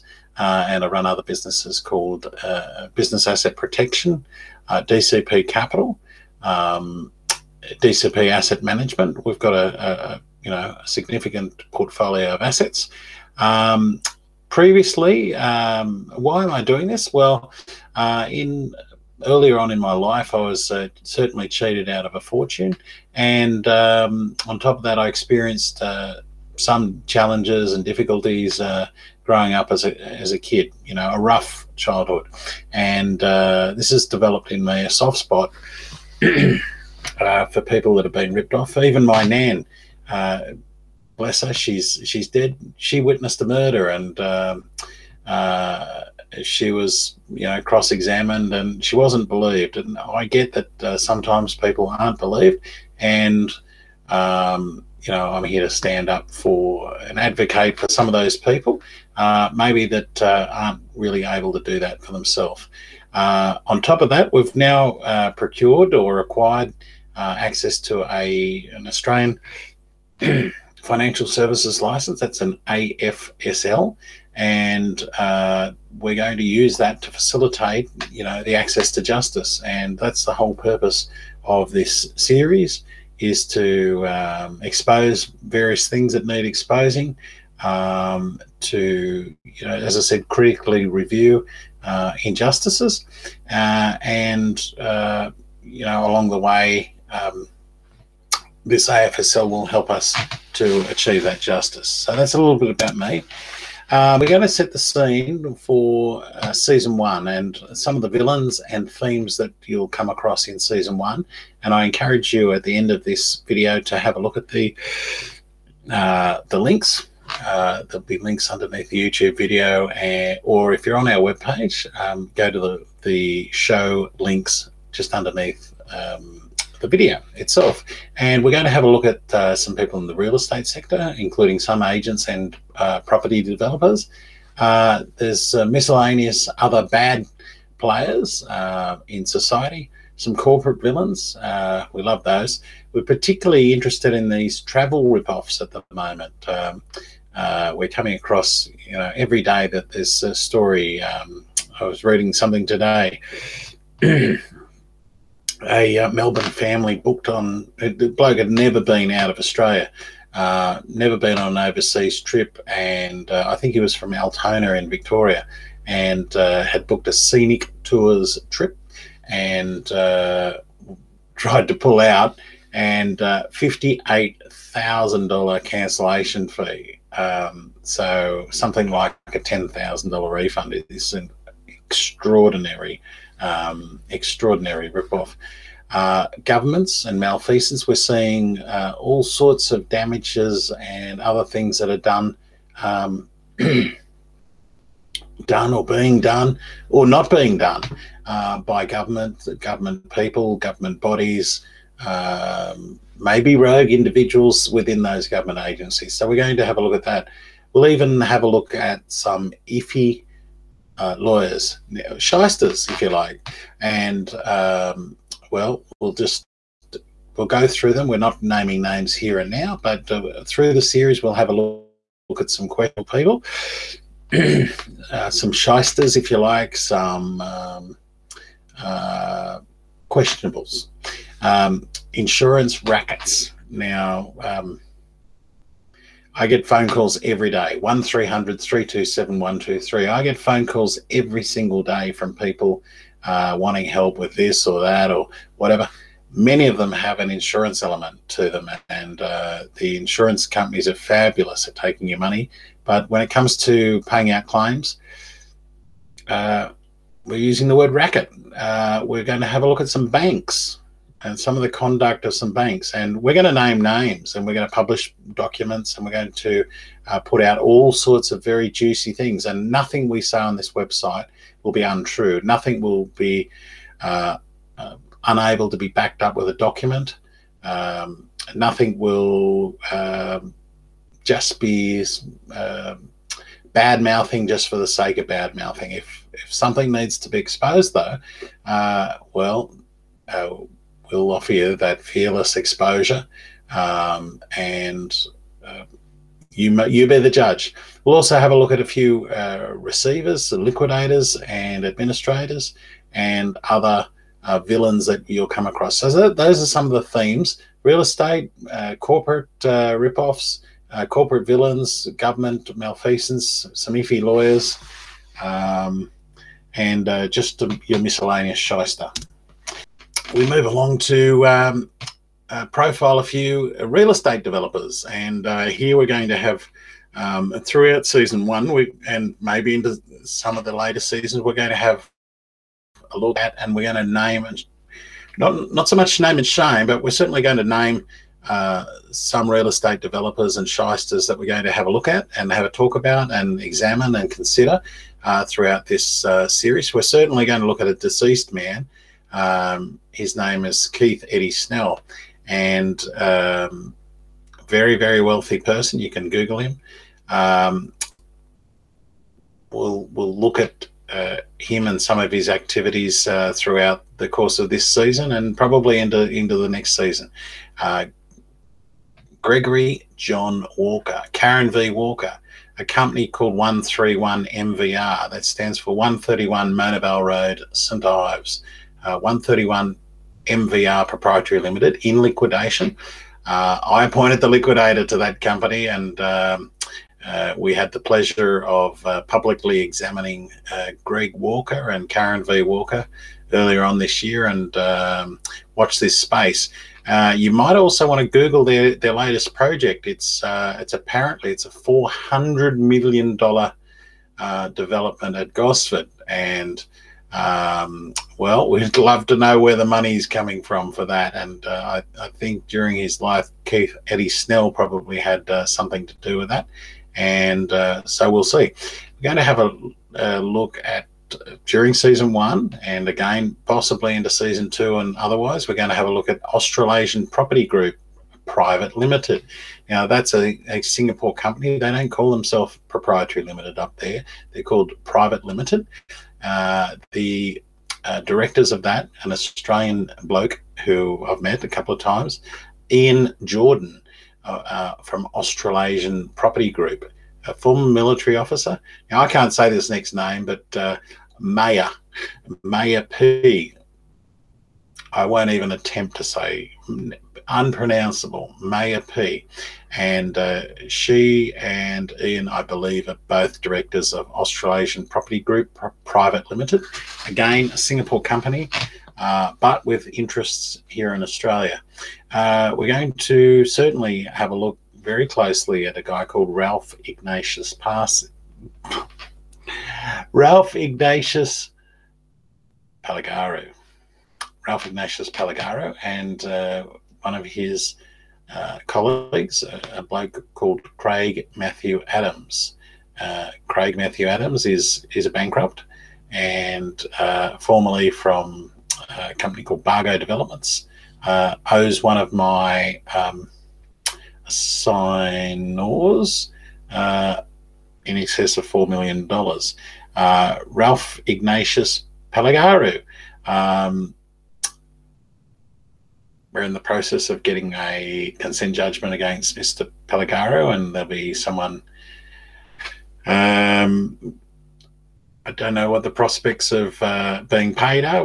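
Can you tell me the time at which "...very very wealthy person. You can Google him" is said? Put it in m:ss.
5:54.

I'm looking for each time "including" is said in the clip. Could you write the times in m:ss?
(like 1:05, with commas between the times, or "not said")
2:11.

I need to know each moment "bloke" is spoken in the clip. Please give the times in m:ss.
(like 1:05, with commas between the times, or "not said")
2:38, 7:20, 8:10.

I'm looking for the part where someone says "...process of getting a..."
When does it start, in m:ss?
8:36.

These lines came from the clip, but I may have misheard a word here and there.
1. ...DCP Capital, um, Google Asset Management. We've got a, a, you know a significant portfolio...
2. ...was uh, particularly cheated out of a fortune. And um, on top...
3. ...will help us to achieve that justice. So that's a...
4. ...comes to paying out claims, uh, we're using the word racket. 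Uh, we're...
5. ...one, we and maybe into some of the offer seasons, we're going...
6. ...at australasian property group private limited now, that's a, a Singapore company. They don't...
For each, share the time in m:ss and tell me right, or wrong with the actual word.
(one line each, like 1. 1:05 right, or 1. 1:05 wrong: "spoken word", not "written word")
1. 0:04 wrong: "DCP", not "Google"
2. 0:20 wrong: "certainly", not "particularly"
3. 1:39 right
4. 4:13 right
5. 5:28 wrong: "later", not "offer"
6. 7:06 right.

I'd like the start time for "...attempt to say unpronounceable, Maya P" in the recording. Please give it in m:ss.
7:35.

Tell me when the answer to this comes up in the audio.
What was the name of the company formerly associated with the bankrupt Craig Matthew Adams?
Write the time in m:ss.
8:19.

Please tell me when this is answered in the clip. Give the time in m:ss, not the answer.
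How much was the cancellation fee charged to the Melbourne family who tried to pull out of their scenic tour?
2:53.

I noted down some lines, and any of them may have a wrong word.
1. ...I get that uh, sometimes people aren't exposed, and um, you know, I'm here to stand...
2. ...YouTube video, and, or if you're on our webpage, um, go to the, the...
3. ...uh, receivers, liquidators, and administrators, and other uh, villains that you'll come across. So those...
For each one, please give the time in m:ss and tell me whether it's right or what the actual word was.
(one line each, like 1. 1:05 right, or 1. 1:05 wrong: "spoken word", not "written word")
1. 0:49 wrong: "believed", not "exposed"
2. 1:59 right
3. 4:59 right.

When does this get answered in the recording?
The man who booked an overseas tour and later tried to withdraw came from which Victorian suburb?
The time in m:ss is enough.
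2:44.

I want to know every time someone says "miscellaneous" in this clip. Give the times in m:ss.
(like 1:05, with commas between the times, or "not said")
2:15, 5:17.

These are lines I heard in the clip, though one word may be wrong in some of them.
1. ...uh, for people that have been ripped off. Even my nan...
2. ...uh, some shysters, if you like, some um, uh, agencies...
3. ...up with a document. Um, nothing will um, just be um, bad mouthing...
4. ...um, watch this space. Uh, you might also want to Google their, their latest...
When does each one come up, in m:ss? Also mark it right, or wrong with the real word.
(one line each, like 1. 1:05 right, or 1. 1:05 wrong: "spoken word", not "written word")
1. 0:37 right
2. 3:45 wrong: "questionables", not "agencies"
3. 4:36 right
4. 6:34 right.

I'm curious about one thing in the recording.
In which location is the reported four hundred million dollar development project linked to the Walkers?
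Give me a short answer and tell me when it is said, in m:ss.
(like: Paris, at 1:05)
Gosford, at 6:45.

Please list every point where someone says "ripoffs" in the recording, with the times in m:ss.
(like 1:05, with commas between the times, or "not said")
2:25, 3:04, 5:09.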